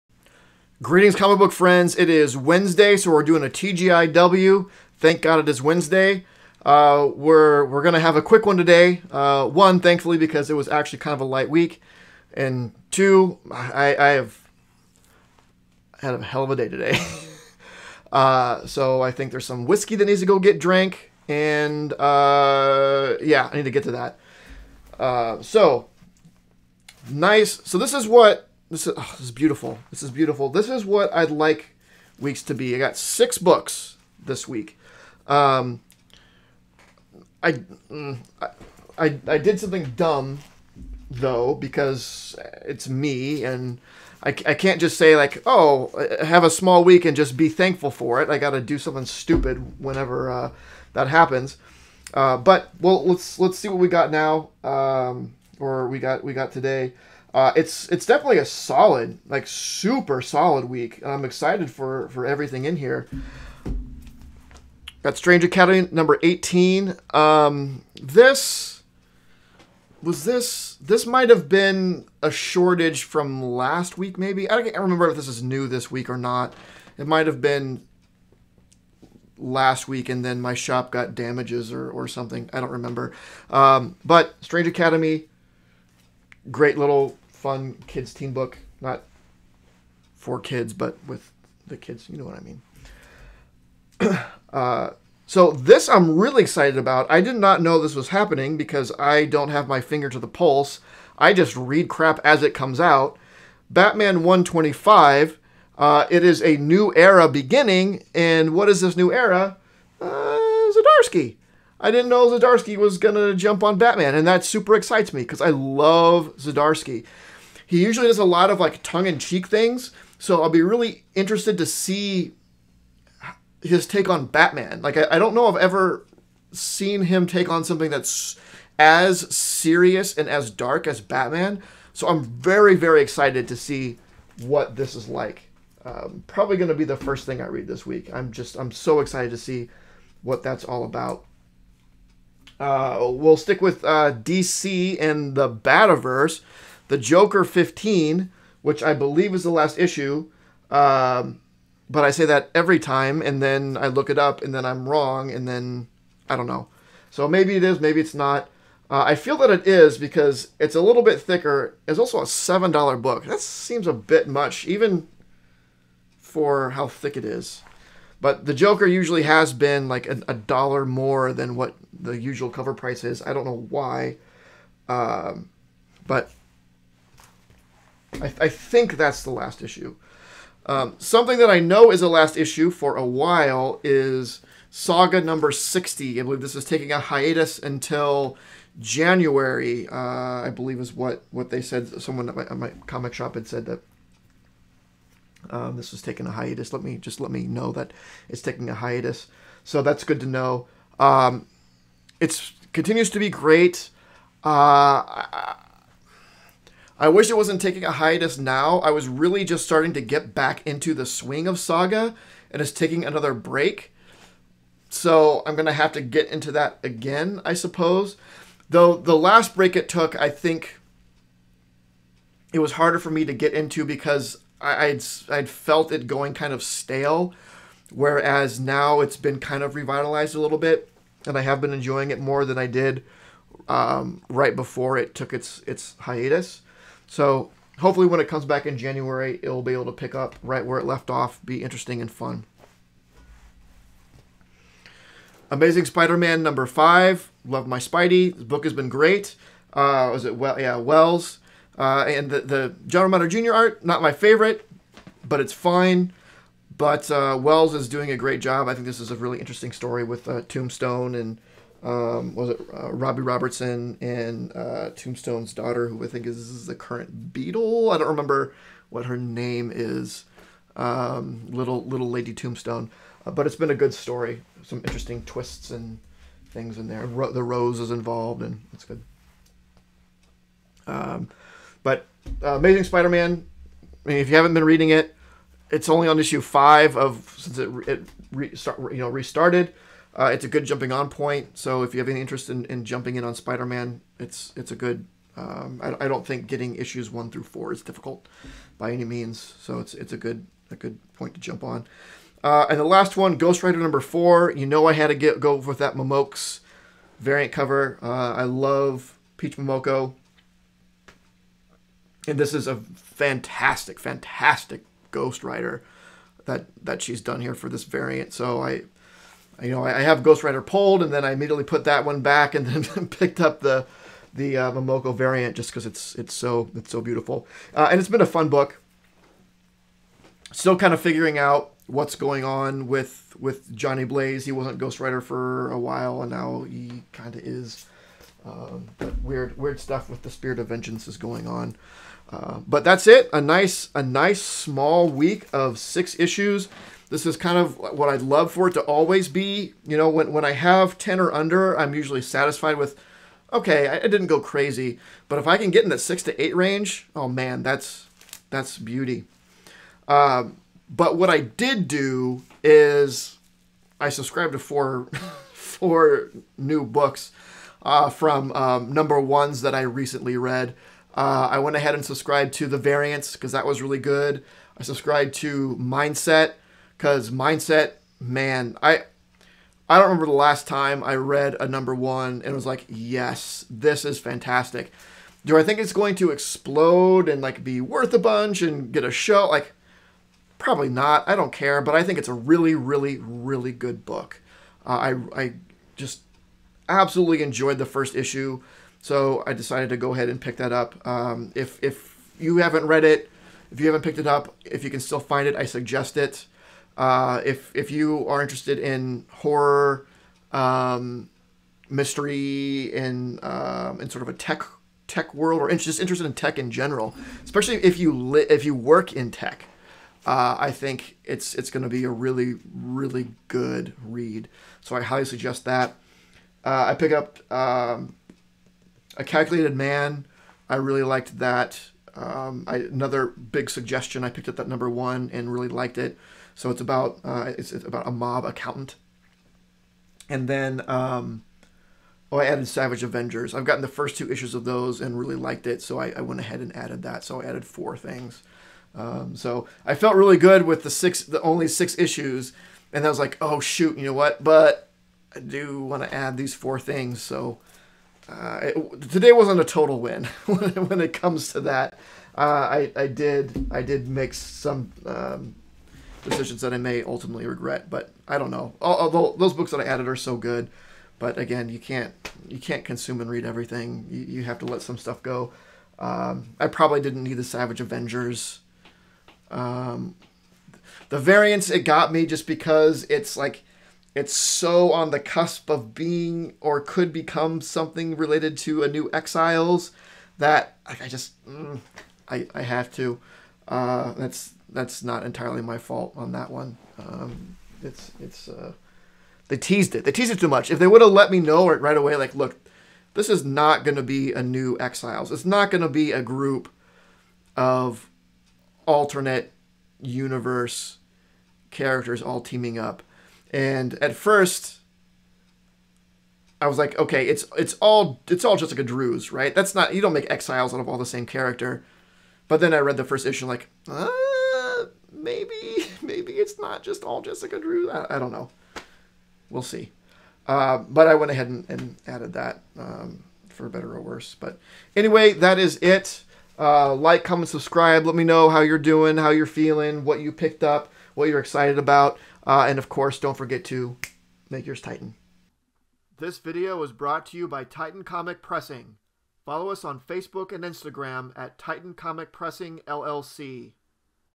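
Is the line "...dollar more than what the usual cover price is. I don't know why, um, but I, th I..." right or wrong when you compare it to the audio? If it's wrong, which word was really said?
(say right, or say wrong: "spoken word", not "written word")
right.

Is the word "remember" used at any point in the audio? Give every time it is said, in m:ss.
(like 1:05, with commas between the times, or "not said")
1:14, 1:22, 4:28, 6:20.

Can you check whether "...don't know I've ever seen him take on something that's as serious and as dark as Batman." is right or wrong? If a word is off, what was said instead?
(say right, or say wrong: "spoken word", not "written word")
right.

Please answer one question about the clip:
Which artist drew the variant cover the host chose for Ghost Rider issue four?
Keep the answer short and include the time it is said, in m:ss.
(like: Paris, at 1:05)
Peach Momoko, at 5:09.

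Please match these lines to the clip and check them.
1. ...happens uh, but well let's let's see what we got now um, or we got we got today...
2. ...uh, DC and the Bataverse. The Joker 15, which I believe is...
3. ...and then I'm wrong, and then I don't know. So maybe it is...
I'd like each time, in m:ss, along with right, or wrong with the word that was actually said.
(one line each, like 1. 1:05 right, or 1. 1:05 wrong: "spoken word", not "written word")
1. 0:51 right
2. 2:23 right
3. 2:34 right.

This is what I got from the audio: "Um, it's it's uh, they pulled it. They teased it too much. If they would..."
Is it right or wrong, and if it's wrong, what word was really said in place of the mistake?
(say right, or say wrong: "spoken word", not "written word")
wrong: "teased", not "pulled".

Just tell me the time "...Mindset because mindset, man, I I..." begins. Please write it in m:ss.
6:15.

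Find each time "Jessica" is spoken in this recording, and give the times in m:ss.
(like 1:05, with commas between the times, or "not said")
8:38, 8:47.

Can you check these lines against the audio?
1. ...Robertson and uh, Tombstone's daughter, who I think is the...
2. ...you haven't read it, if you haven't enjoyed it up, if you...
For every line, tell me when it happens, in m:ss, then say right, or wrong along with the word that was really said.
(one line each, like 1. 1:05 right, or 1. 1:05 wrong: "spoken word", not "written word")
1. 4:23 right
2. 6:42 wrong: "picked", not "enjoyed".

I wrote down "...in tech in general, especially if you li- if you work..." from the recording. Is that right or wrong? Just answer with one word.
right.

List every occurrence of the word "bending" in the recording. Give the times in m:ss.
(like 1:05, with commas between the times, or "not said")
not said.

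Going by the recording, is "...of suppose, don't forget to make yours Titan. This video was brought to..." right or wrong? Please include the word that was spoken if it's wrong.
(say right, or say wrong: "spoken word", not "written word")
wrong: "course", not "suppose".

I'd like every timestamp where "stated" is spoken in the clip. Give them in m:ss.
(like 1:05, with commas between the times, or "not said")
not said.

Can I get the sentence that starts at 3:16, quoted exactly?
Let me just let me know that it's taking a hiatus.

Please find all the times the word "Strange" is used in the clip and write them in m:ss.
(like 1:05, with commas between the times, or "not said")
1:05, 1:24.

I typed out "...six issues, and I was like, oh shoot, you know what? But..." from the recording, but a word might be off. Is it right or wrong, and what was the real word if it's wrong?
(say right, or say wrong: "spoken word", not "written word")
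right.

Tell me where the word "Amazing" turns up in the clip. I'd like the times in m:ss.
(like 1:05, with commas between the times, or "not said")
4:05, 4:42.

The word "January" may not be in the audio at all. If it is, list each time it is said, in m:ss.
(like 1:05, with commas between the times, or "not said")
3:08, 3:58.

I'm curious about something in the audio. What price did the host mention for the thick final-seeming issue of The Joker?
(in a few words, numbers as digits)
$7.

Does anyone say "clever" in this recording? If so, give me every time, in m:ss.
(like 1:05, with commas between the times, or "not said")
not said.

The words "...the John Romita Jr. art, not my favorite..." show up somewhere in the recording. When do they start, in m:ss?
4:12.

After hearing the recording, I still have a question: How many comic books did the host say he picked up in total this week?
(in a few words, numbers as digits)
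6.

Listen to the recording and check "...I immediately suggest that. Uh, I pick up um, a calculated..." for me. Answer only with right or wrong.
wrong.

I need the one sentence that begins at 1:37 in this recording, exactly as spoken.
I did not know this was happening because I don't have my finger to the pulse.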